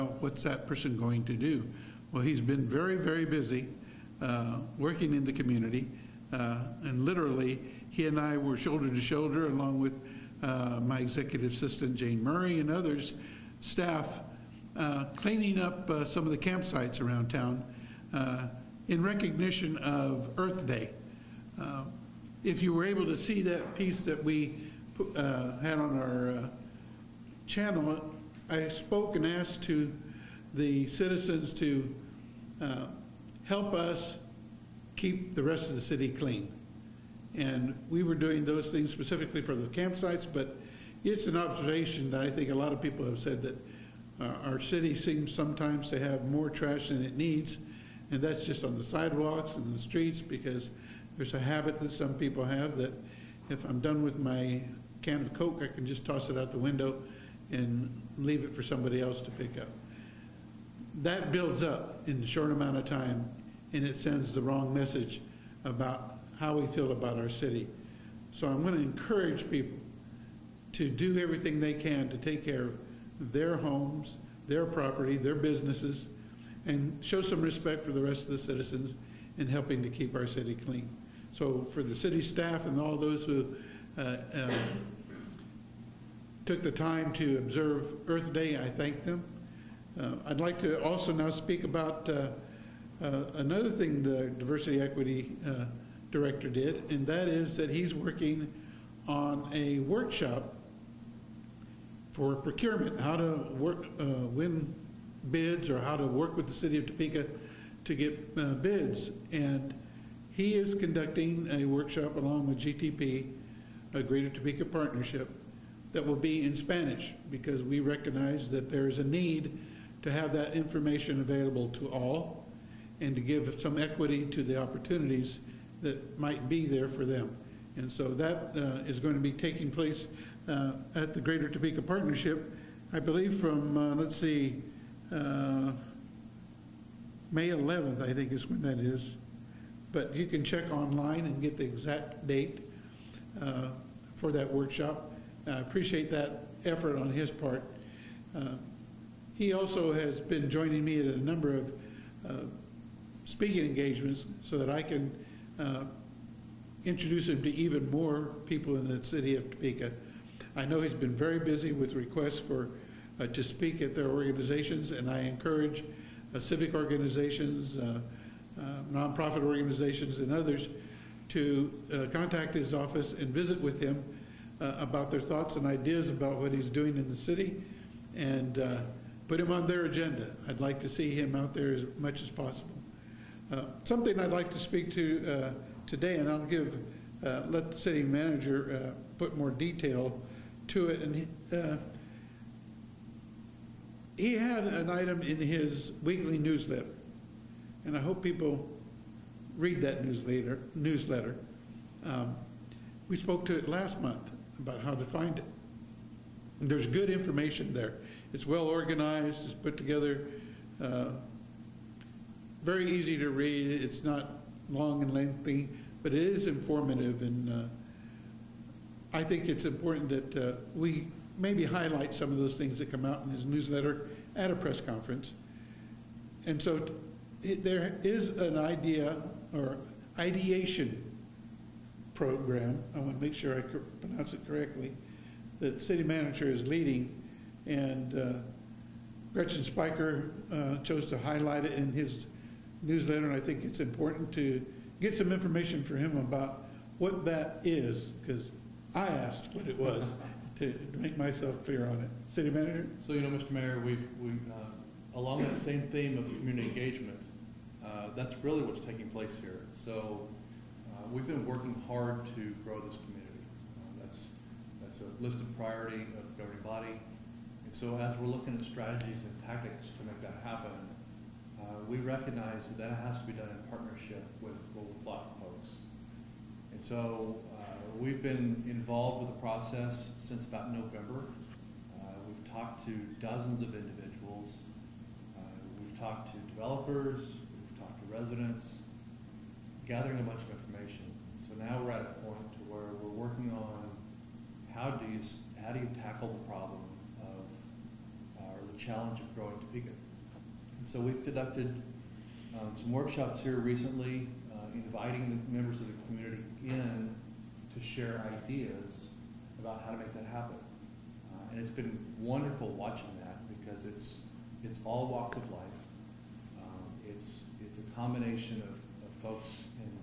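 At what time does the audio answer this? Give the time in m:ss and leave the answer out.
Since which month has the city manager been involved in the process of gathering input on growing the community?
4:40.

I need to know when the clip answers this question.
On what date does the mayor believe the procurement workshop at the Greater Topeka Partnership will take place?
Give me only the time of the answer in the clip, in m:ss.
2:17.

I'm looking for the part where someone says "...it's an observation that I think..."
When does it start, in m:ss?
0:41.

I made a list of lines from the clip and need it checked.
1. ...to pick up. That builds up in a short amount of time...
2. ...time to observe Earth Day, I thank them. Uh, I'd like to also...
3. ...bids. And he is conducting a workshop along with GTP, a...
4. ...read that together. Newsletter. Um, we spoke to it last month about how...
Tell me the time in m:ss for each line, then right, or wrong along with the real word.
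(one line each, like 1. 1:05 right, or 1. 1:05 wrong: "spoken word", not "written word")
1. 0:59 right
2. 1:26 right
3. 1:48 right
4. 3:19 wrong: "newsletter", not "together".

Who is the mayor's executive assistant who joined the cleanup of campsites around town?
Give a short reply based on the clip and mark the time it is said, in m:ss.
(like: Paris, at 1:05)
Jane Murray, at 0:11.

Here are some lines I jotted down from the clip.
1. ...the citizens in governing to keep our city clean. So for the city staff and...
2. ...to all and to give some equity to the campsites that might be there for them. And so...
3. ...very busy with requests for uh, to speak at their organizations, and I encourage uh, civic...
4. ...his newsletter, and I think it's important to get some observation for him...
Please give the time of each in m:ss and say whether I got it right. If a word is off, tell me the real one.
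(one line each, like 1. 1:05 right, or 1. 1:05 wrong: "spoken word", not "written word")
1. 1:18 wrong: "helping", not "governing"
2. 2:01 wrong: "opportunities", not "campsites"
3. 2:41 right
4. 4:01 wrong: "information", not "observation".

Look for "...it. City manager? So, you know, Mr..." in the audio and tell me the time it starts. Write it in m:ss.
4:12.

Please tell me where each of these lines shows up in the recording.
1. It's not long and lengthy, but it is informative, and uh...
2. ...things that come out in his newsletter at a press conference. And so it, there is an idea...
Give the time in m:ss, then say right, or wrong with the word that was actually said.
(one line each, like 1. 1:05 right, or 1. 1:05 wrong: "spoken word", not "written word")
1. 3:33 right
2. 3:42 right.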